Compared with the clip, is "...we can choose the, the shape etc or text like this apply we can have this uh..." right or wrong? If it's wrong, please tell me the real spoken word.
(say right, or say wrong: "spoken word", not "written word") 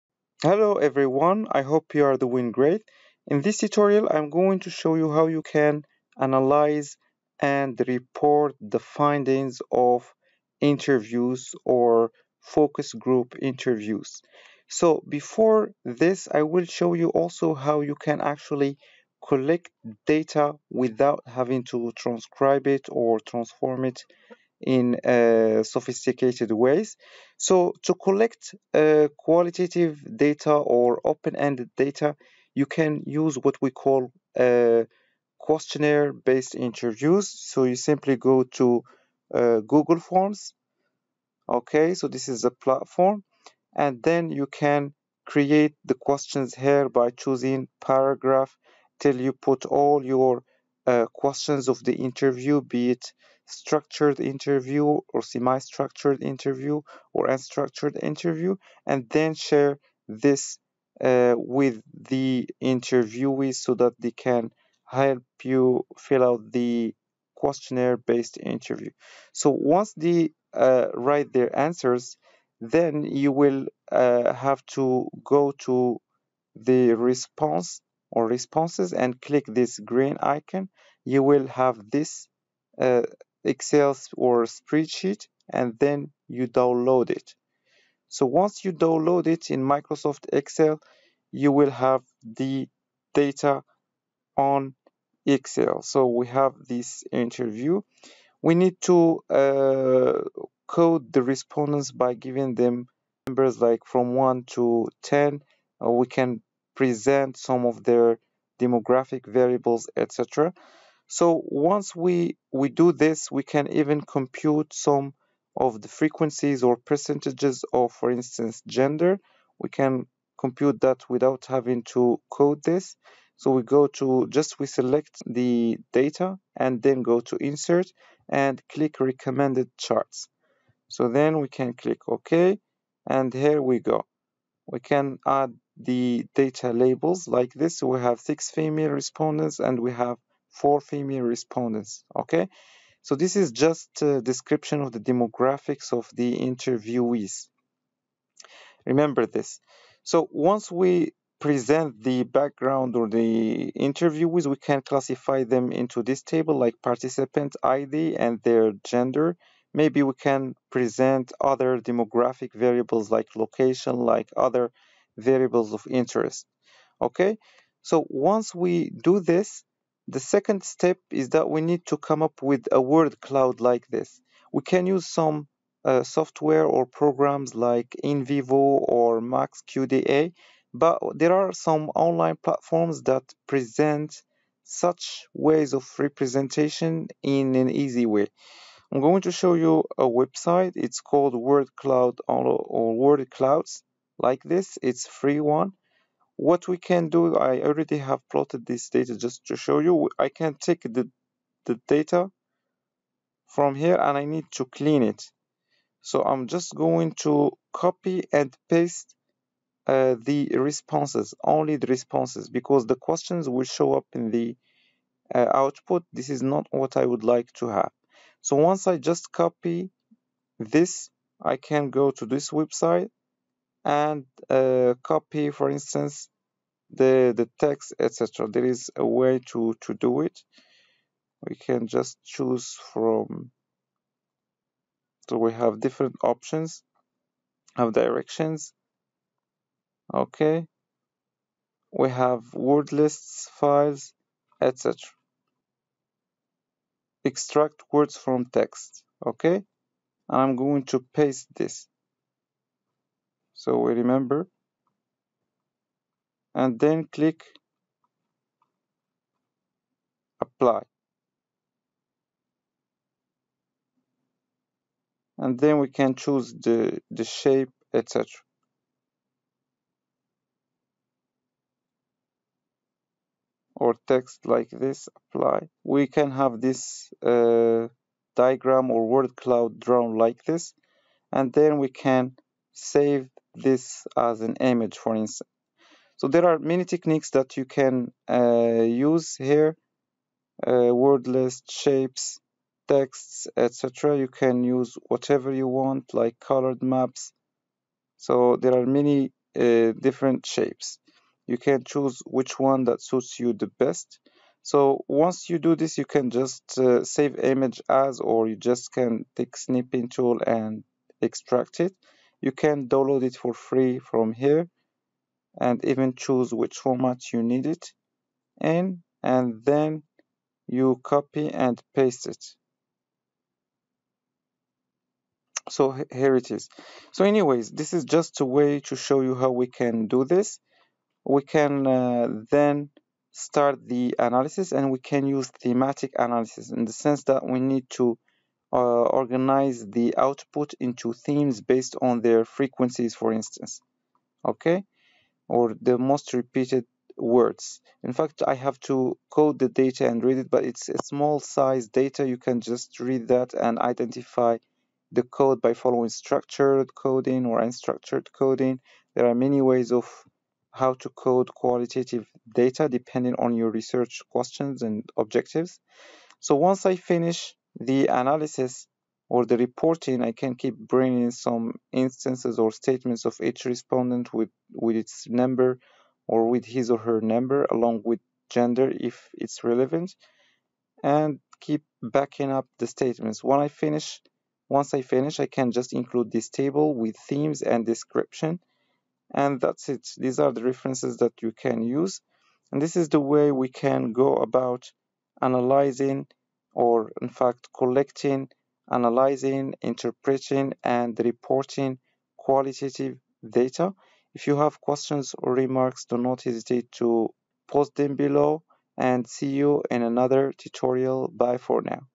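right.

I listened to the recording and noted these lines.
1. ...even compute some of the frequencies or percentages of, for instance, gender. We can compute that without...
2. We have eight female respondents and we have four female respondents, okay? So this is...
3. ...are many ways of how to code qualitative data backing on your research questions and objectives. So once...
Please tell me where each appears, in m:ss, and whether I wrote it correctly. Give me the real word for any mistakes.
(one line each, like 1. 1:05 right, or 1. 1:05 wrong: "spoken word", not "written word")
1. 1:53 right
2. 2:17 wrong: "six", not "eight"
3. 5:59 wrong: "depending", not "backing".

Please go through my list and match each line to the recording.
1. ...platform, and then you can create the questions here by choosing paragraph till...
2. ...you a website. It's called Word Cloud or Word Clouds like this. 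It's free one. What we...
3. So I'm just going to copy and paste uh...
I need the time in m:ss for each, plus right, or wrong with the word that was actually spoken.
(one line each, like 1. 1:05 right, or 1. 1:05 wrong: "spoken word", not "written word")
1. 0:42 right
2. 3:09 right
3. 3:26 right.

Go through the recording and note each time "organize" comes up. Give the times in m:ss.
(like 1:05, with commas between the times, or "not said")
5:39.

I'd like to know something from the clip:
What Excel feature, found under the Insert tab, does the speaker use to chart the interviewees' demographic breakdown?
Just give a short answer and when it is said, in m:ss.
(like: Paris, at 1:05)
Recommended charts, at 2:08.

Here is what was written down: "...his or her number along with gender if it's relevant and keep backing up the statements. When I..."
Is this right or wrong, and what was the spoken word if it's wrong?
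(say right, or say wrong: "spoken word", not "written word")
right.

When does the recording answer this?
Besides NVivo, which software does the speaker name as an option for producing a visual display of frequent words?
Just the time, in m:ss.
2:59.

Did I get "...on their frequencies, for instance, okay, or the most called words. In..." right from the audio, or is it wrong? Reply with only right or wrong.
wrong.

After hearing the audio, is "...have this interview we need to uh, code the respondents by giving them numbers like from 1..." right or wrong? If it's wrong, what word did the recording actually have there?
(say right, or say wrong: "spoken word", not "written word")
right.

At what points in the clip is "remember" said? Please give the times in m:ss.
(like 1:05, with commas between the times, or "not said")
2:28, 4:13.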